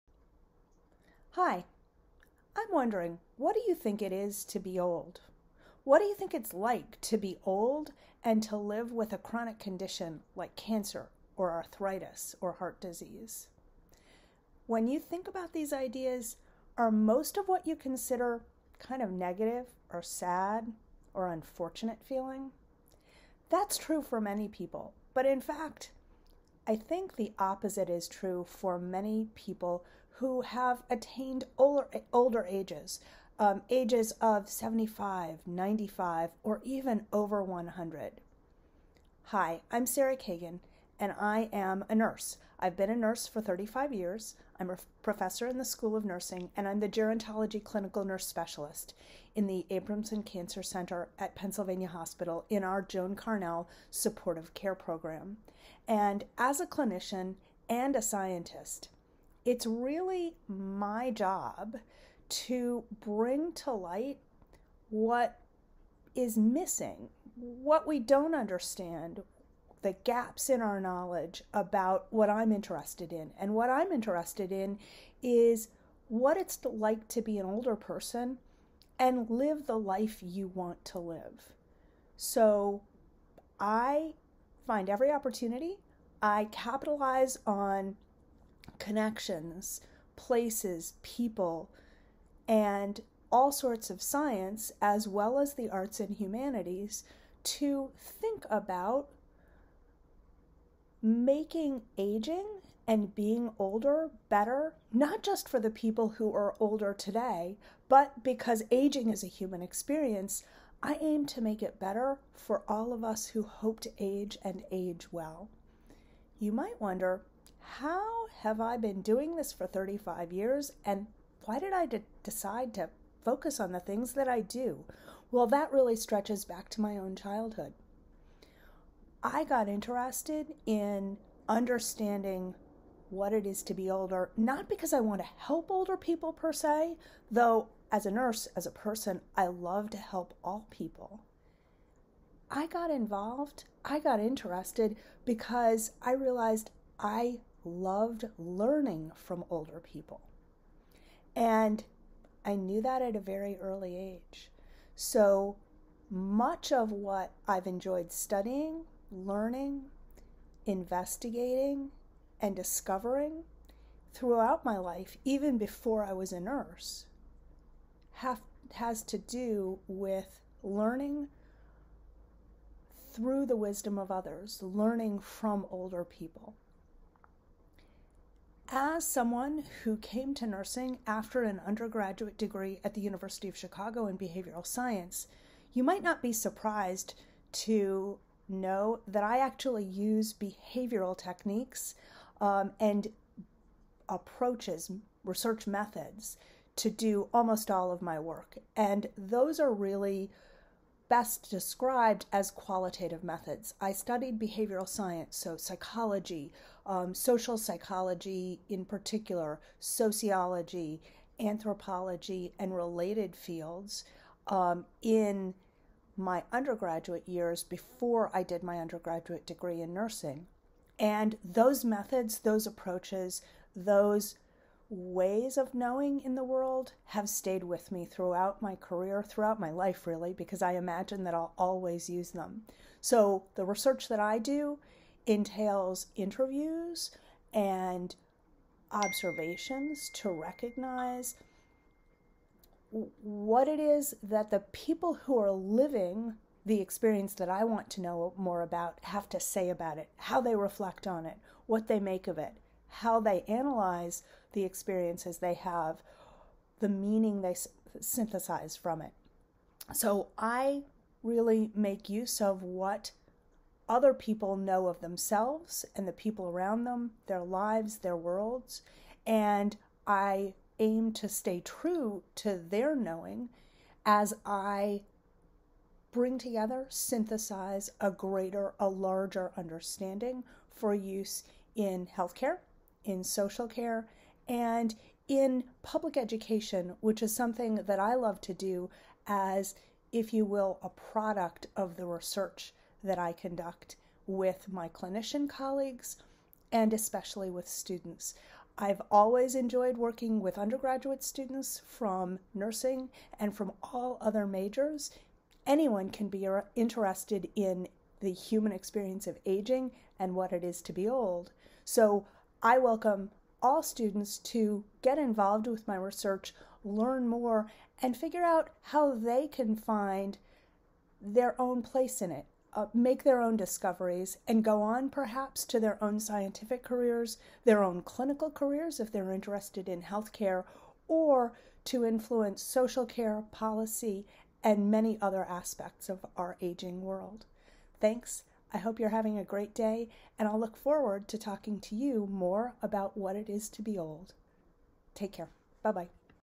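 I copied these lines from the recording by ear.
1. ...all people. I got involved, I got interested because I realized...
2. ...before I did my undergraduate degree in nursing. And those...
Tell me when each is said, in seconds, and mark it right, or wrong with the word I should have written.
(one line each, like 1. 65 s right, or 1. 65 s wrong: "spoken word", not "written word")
1. 140 s right
2. 217 s right.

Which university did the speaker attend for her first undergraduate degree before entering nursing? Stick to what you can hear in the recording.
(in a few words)
University of Chicago.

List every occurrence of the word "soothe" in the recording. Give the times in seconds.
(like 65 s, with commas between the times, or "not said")
not said.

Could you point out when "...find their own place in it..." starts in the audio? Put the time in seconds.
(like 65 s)
319 s.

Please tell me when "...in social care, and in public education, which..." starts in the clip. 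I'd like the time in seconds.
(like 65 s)
283 s.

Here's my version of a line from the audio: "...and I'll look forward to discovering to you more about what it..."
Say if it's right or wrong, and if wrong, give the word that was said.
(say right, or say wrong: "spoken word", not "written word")
wrong: "talking", not "discovering".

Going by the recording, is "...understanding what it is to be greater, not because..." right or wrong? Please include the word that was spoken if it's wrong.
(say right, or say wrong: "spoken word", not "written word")
wrong: "older", not "greater".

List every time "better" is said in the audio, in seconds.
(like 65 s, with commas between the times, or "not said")
104 s, 111 s.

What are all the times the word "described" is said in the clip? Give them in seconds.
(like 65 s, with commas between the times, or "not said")
201 s.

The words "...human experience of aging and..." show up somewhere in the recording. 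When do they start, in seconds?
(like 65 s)
308 s.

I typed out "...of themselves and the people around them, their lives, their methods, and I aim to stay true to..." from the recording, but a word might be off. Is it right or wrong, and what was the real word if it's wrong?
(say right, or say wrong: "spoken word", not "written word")
wrong: "worlds", not "methods".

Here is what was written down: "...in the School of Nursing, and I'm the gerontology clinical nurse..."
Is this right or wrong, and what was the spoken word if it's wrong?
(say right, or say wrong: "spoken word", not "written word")
right.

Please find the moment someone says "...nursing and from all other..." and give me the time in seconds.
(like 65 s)
302 s.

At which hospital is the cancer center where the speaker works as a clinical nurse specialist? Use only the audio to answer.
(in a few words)
Pennsylvania Hospital.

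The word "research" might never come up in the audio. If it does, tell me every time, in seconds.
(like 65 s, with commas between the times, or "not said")
195 s, 233 s, 292 s, 315 s.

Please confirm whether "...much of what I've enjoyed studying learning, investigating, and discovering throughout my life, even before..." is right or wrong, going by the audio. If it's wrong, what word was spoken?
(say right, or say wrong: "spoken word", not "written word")
right.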